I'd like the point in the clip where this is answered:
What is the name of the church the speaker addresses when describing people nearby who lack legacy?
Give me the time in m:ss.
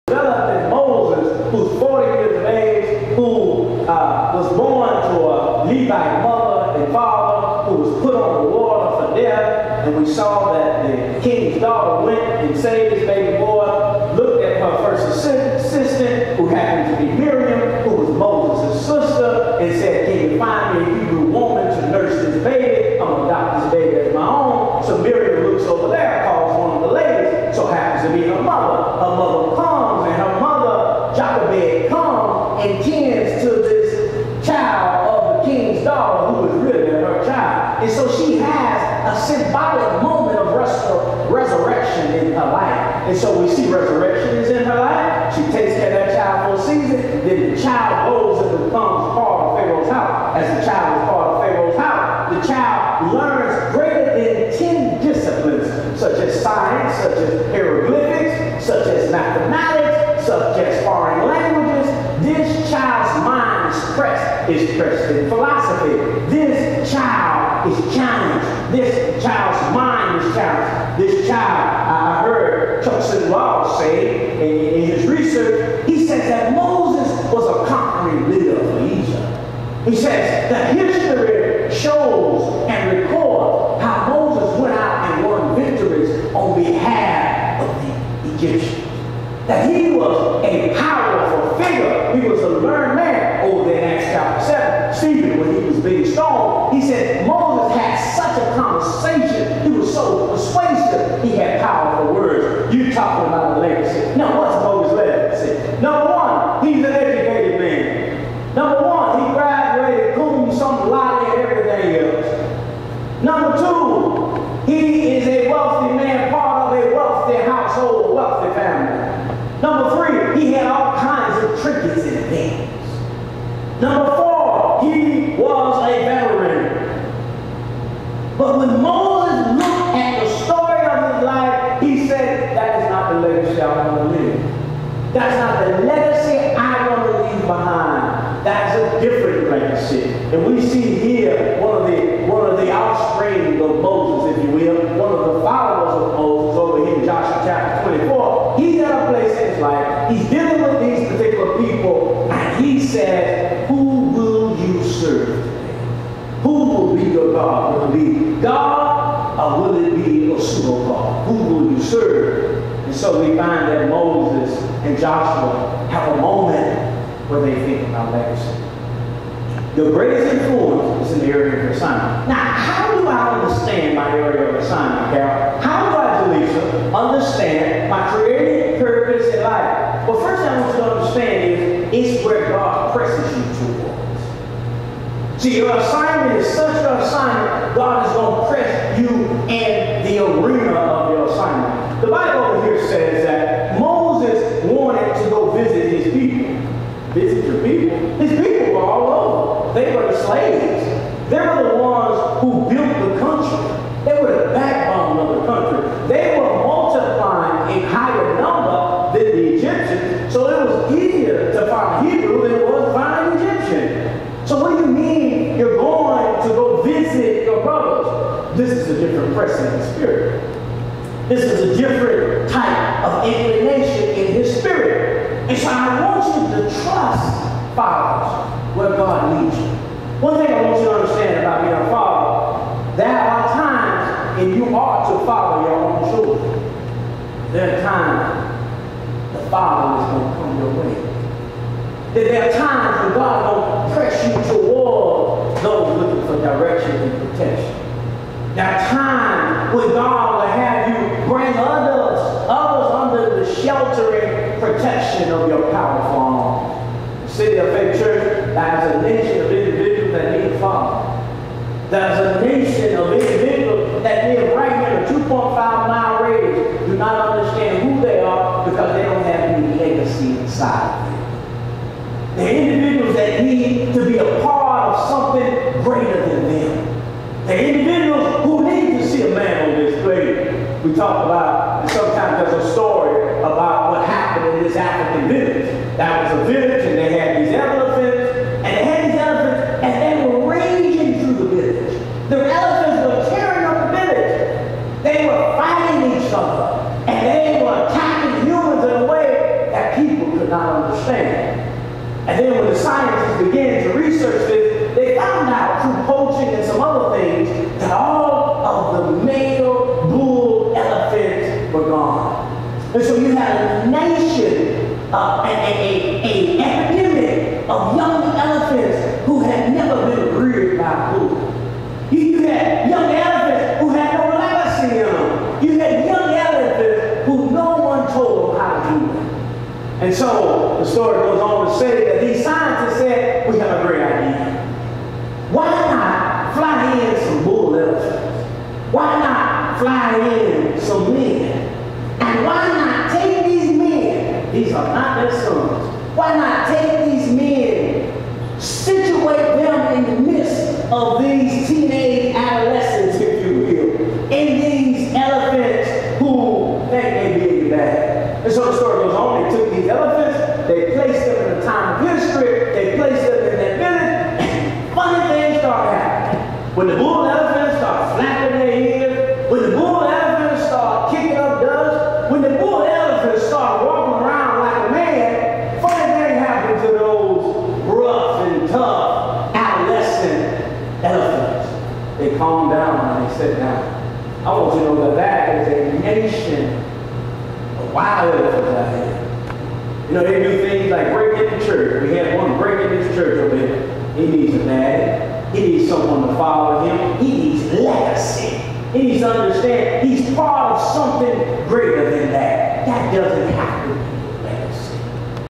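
4:17.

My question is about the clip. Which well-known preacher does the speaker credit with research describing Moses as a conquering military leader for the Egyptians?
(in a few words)
Chuck Swindoll.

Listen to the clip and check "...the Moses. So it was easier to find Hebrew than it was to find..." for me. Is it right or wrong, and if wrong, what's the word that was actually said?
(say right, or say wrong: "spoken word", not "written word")
wrong: "Egyptians", not "Moses".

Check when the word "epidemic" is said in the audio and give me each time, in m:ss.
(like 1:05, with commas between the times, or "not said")
5:16.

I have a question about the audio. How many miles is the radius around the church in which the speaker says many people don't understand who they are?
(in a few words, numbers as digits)
2.5.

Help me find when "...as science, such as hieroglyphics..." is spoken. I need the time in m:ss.
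0:56.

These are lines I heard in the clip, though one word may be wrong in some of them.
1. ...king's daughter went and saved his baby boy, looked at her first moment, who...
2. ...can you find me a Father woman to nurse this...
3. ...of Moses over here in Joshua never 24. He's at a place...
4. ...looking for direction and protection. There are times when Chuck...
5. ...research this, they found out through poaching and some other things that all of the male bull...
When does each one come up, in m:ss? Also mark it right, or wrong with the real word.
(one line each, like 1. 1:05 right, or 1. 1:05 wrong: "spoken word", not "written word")
1. 0:11 wrong: "assistant", not "moment"
2. 0:20 wrong: "Hebrew", not "Father"
3. 2:26 wrong: "chapter", not "never"
4. 4:05 wrong: "God", not "Chuck"
5. 5:03 right.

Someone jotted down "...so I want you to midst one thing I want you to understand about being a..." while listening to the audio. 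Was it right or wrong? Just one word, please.
wrong.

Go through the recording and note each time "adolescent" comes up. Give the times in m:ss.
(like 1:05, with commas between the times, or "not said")
6:19.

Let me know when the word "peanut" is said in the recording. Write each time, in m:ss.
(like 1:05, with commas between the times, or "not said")
not said.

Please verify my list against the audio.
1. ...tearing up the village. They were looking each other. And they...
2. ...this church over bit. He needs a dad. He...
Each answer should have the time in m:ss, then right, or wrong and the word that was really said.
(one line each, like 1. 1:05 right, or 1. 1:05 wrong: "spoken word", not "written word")
1. 4:53 wrong: "fighting", not "looking"
2. 6:33 right.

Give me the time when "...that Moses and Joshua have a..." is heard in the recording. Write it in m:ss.
2:43.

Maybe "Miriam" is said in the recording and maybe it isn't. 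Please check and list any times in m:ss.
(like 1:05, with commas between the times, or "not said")
0:17, 0:25.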